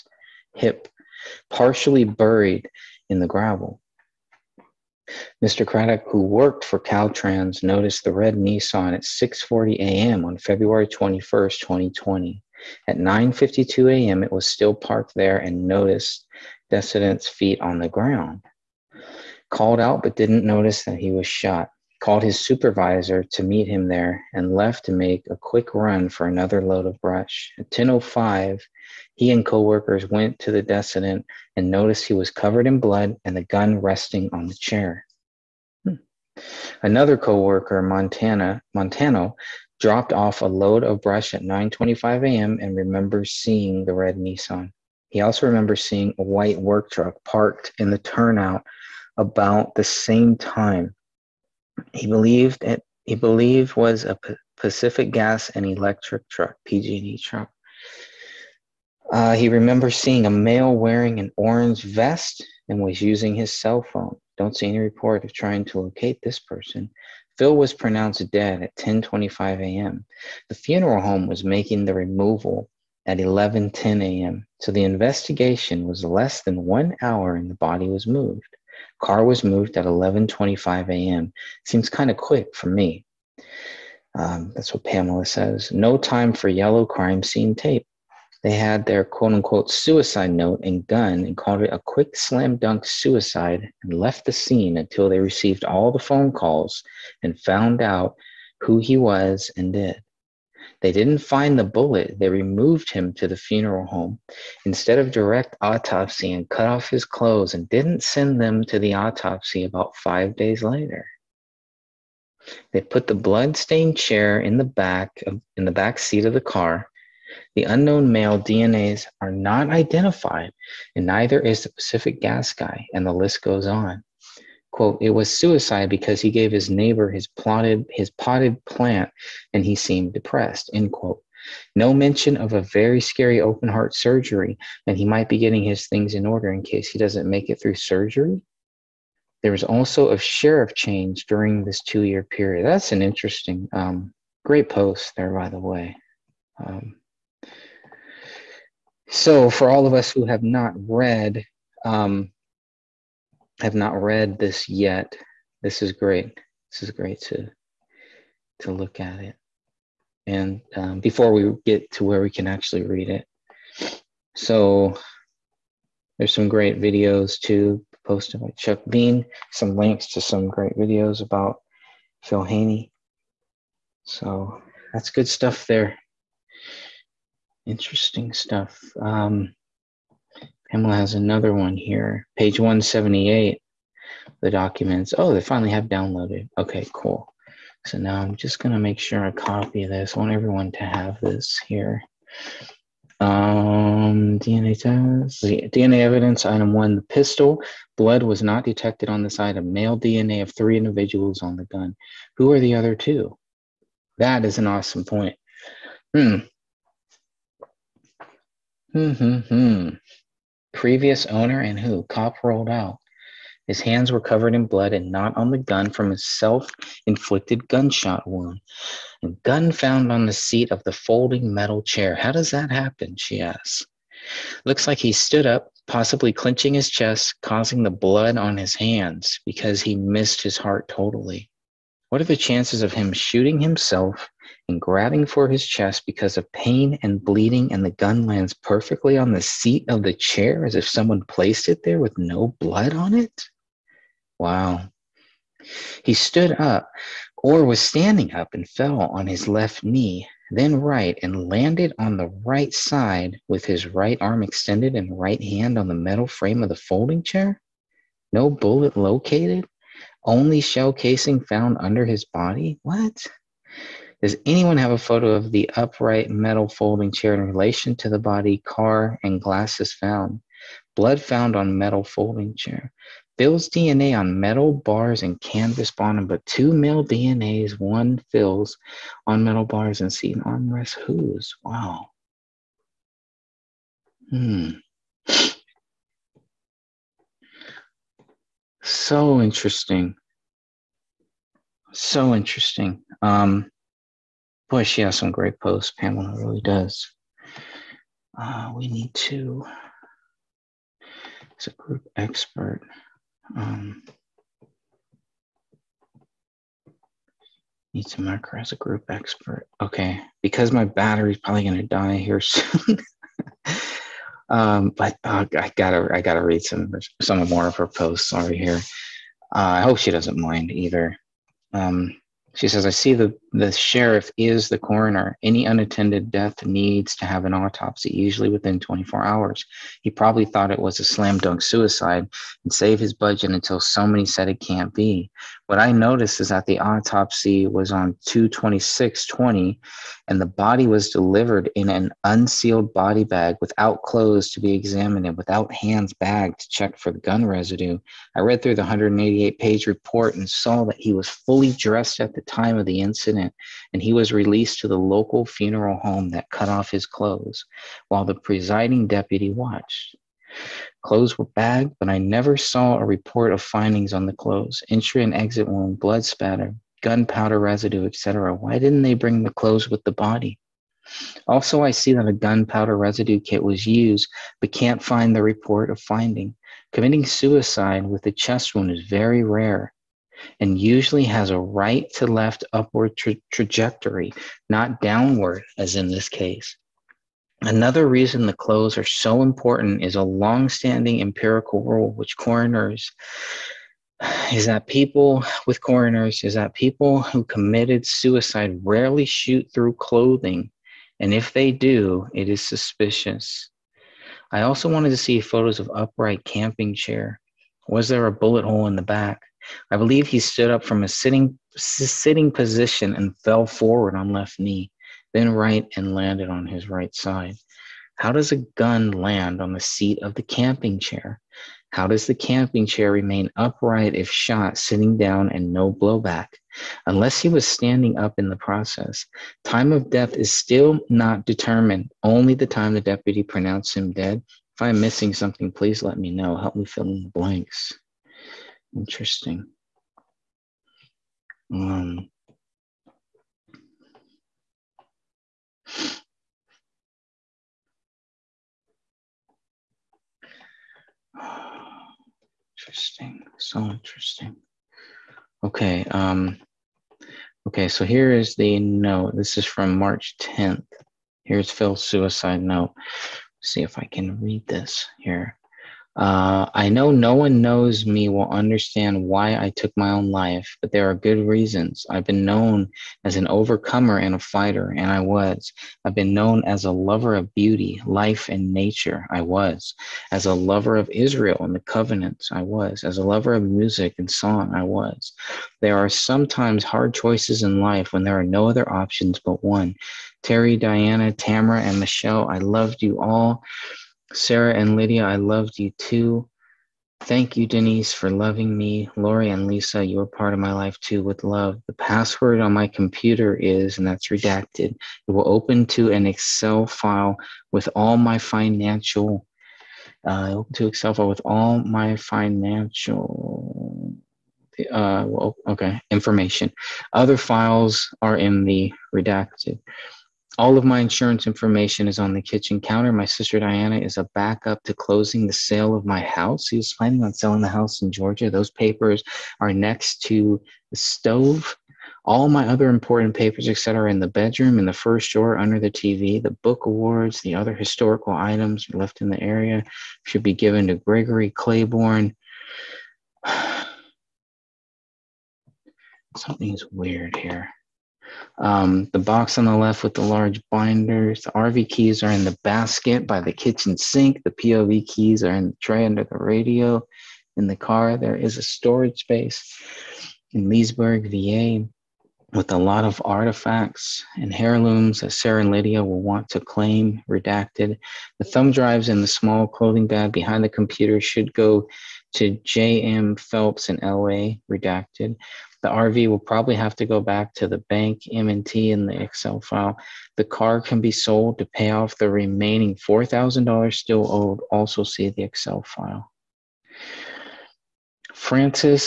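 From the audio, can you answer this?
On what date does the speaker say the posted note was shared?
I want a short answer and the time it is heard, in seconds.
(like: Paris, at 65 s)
March 10th, at 459 s.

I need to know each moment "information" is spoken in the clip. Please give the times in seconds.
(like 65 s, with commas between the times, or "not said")
516 s, 521 s.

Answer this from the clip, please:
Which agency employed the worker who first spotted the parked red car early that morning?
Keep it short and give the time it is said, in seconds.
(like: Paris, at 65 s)
Caltrans, at 6 s.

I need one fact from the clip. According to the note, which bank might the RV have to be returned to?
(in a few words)
M&T.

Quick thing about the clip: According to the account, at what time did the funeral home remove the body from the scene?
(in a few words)
11:10 a.m.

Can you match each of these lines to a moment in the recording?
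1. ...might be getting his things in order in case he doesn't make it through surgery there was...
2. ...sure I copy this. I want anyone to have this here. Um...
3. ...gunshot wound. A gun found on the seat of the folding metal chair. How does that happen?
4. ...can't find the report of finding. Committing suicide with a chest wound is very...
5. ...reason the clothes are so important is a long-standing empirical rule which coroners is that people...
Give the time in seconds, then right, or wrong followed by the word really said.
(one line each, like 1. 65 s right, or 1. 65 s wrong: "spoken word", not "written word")
1. 135 s right
2. 188 s wrong: "everyone", not "anyone"
3. 217 s right
4. 374 s right
5. 388 s right.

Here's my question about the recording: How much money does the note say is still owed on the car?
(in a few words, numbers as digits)
$4,000.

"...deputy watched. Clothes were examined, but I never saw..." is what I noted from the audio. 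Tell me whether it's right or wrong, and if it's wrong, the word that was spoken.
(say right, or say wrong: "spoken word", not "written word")
wrong: "bagged", not "examined".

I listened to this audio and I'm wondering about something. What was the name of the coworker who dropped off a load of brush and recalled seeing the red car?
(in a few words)
Montana Montano.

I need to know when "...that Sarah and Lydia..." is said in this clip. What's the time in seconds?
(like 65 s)
565 s.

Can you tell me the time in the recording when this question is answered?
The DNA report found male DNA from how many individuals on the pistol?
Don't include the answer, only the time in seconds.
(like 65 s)
200 s.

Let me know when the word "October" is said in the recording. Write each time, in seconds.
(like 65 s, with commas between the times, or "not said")
not said.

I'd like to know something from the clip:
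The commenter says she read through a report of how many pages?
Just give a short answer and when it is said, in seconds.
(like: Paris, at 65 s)
188, at 348 s.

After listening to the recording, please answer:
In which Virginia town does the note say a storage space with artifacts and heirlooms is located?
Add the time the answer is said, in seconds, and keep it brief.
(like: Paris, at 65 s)
Leesburg, at 560 s.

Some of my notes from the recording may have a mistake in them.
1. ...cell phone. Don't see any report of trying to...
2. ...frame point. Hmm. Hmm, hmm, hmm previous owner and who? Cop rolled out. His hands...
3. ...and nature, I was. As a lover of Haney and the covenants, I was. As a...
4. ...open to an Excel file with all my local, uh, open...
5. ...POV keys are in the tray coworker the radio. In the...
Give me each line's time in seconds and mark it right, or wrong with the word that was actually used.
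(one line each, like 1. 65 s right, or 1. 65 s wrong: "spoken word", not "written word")
1. 63 s right
2. 204 s wrong: "awesome", not "frame"
3. 478 s wrong: "Israel", not "Haney"
4. 505 s wrong: "financial", not "local"
5. 554 s wrong: "under", not "coworker".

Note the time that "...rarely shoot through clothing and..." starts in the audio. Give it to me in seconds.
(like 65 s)
398 s.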